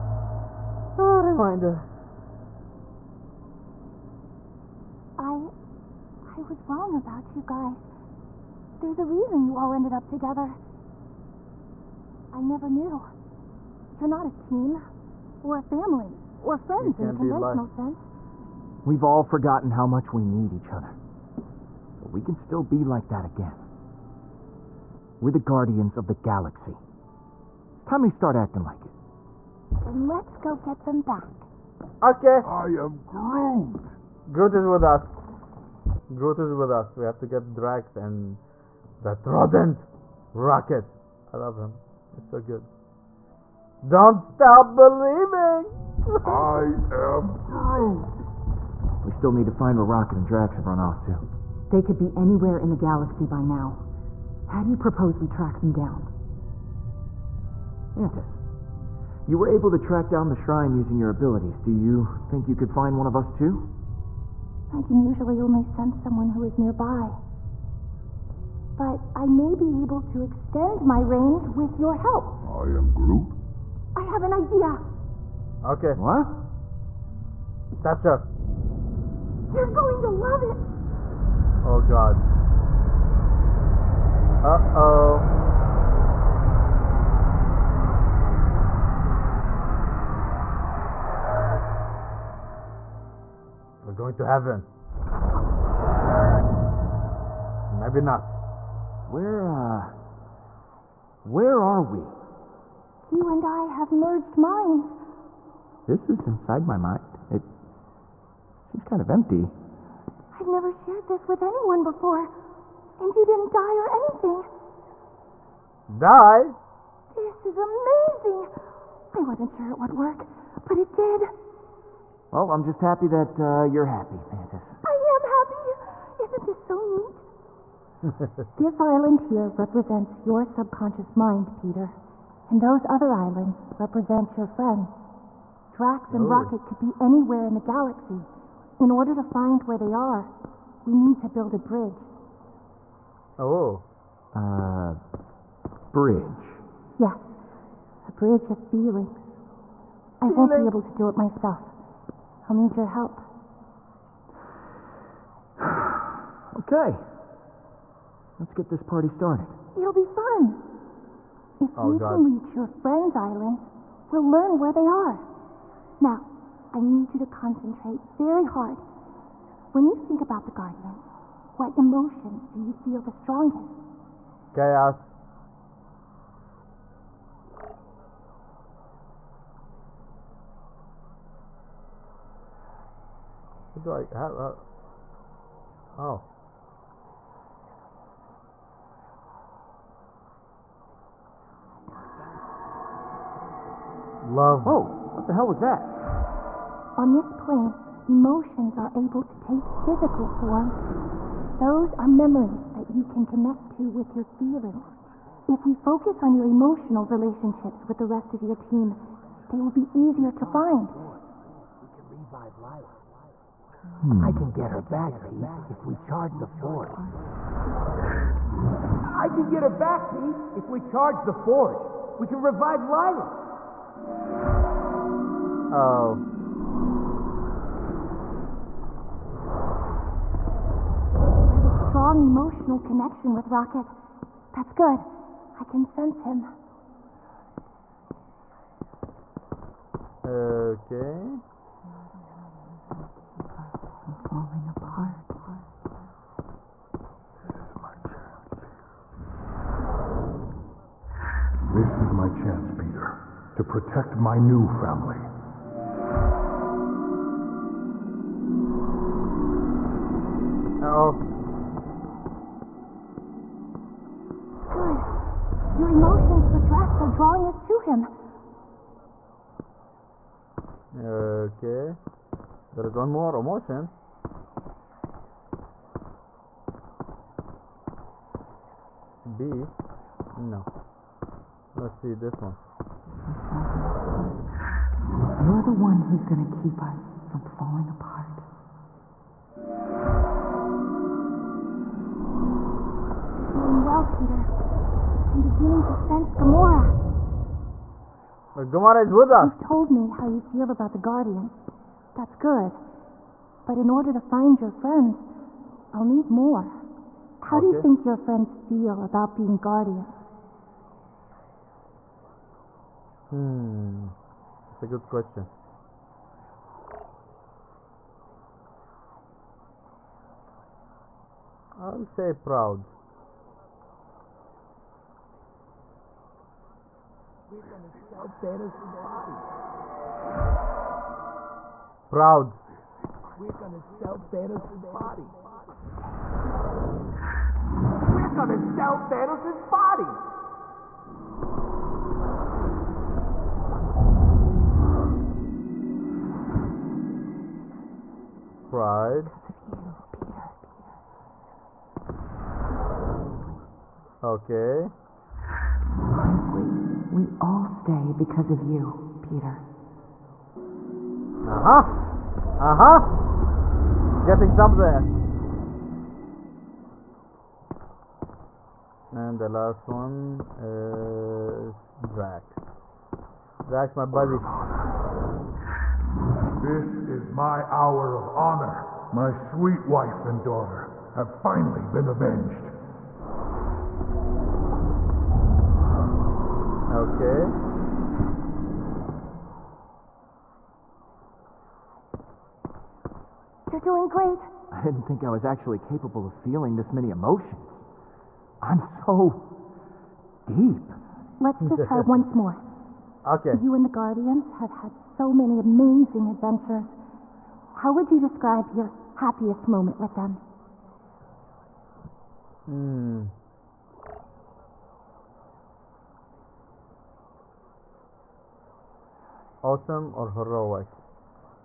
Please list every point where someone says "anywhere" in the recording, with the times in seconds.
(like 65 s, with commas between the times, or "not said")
52 s, 136 s.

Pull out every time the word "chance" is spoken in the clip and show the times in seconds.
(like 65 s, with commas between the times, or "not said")
248 s, 252 s.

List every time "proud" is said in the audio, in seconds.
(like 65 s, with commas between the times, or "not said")
322 s, 332 s.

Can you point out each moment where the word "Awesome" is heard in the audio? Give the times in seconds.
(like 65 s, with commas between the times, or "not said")
419 s.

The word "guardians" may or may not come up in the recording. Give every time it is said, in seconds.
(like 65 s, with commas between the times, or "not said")
25 s, 170 s, 300 s, 309 s, 403 s.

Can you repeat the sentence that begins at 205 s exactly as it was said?
If we focus on your emotional relationships with the rest of your team, they will be easier to find.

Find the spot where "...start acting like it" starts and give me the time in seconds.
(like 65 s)
28 s.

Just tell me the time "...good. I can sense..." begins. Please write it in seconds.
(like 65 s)
234 s.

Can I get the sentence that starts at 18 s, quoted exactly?
We've all forgotten how much we need each other.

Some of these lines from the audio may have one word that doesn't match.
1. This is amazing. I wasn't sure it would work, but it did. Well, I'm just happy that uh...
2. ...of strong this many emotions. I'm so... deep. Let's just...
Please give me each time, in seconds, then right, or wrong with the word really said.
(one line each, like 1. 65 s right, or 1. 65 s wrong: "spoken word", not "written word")
1. 117 s right
2. 396 s wrong: "feeling", not "strong".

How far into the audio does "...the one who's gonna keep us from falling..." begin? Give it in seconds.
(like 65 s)
285 s.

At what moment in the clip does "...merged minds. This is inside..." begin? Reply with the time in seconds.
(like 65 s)
103 s.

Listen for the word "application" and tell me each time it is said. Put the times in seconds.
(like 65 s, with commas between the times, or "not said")
not said.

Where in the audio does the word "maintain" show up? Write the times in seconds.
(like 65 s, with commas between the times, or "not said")
not said.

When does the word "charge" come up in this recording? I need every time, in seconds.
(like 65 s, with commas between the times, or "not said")
215 s, 220 s.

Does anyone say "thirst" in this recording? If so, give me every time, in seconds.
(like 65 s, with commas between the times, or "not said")
not said.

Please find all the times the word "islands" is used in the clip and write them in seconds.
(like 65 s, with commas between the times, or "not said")
128 s, 133 s, 163 s.